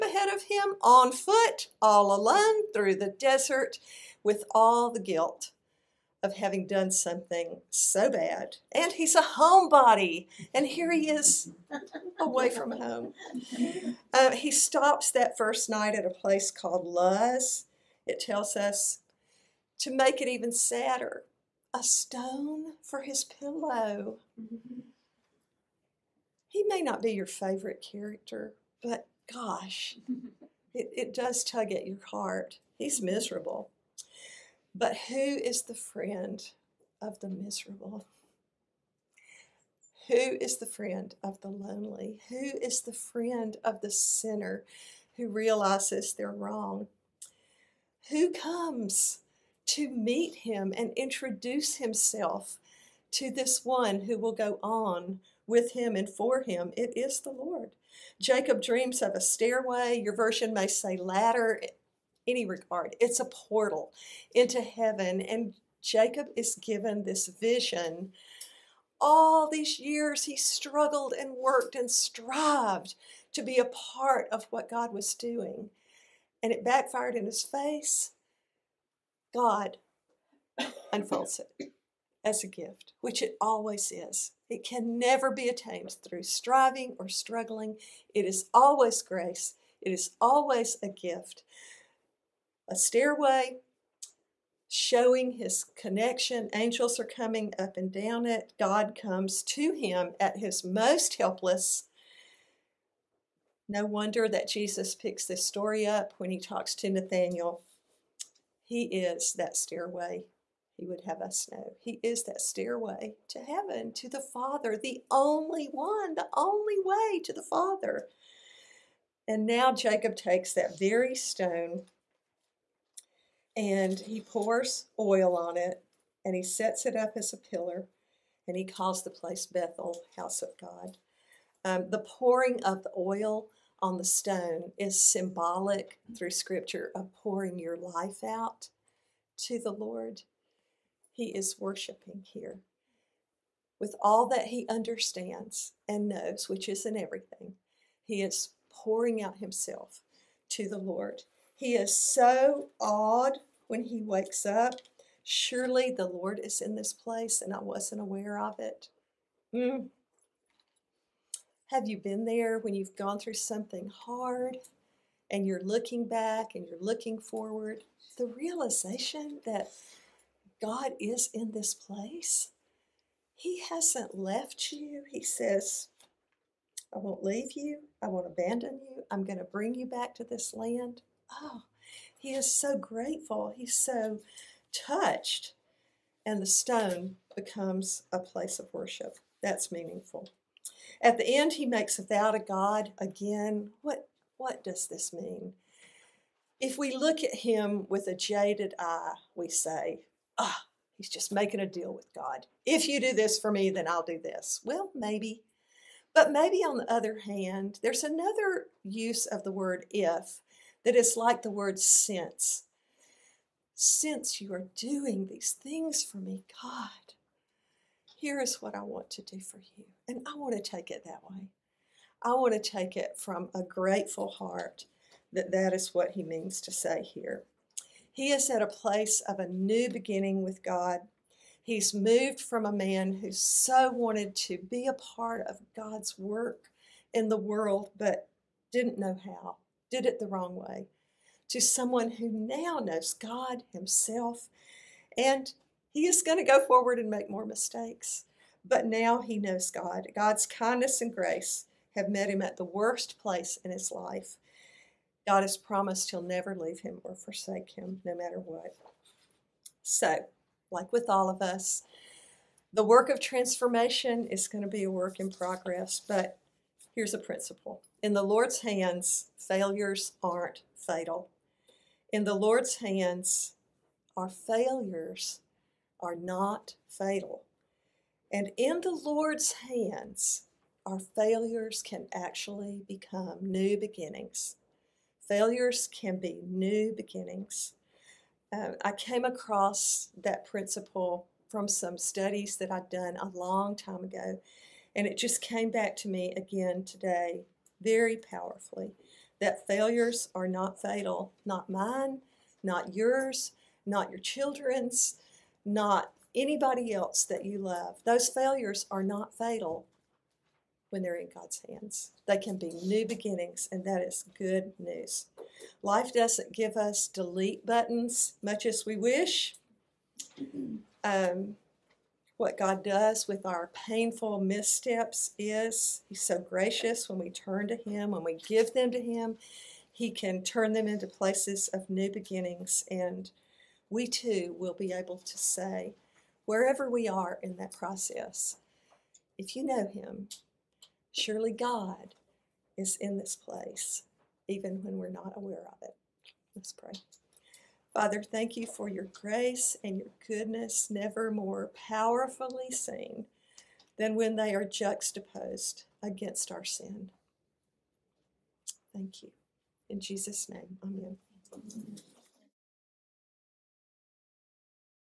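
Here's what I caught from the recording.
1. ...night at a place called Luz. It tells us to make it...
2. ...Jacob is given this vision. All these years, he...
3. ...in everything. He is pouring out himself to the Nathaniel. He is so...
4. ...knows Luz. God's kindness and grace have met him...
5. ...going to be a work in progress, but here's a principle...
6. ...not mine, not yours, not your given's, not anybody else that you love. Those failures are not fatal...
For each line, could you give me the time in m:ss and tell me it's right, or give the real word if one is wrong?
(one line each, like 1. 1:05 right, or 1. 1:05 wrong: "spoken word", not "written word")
1. 0:15 right
2. 1:05 right
3. 2:26 wrong: "Lord", not "Nathaniel"
4. 4:09 wrong: "God", not "Luz"
5. 4:24 right
6. 5:01 wrong: "children", not "given".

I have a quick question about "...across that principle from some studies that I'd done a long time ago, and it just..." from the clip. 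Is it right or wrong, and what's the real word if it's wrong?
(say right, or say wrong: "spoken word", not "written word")
right.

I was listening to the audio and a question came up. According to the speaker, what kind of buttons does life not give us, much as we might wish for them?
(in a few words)
Delete buttons.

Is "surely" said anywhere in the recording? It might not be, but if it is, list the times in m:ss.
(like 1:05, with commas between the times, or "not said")
2:35, 5:41.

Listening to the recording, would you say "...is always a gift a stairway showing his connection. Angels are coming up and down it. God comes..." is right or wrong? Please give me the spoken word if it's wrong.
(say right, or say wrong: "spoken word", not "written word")
right.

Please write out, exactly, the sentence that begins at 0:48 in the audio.
Who comes to meet him and introduce himself to this one who will go on with him and for him?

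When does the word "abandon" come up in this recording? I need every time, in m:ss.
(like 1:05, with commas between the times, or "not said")
2:58.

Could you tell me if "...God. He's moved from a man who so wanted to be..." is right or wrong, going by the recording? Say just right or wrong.
right.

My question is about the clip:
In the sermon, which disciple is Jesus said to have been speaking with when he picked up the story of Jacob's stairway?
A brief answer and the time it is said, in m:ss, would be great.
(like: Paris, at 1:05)
Nathaniel, at 1:46.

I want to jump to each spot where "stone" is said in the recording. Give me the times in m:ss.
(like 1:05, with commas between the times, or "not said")
0:21, 2:01, 2:14, 3:06.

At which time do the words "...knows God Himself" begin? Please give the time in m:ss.
4:02.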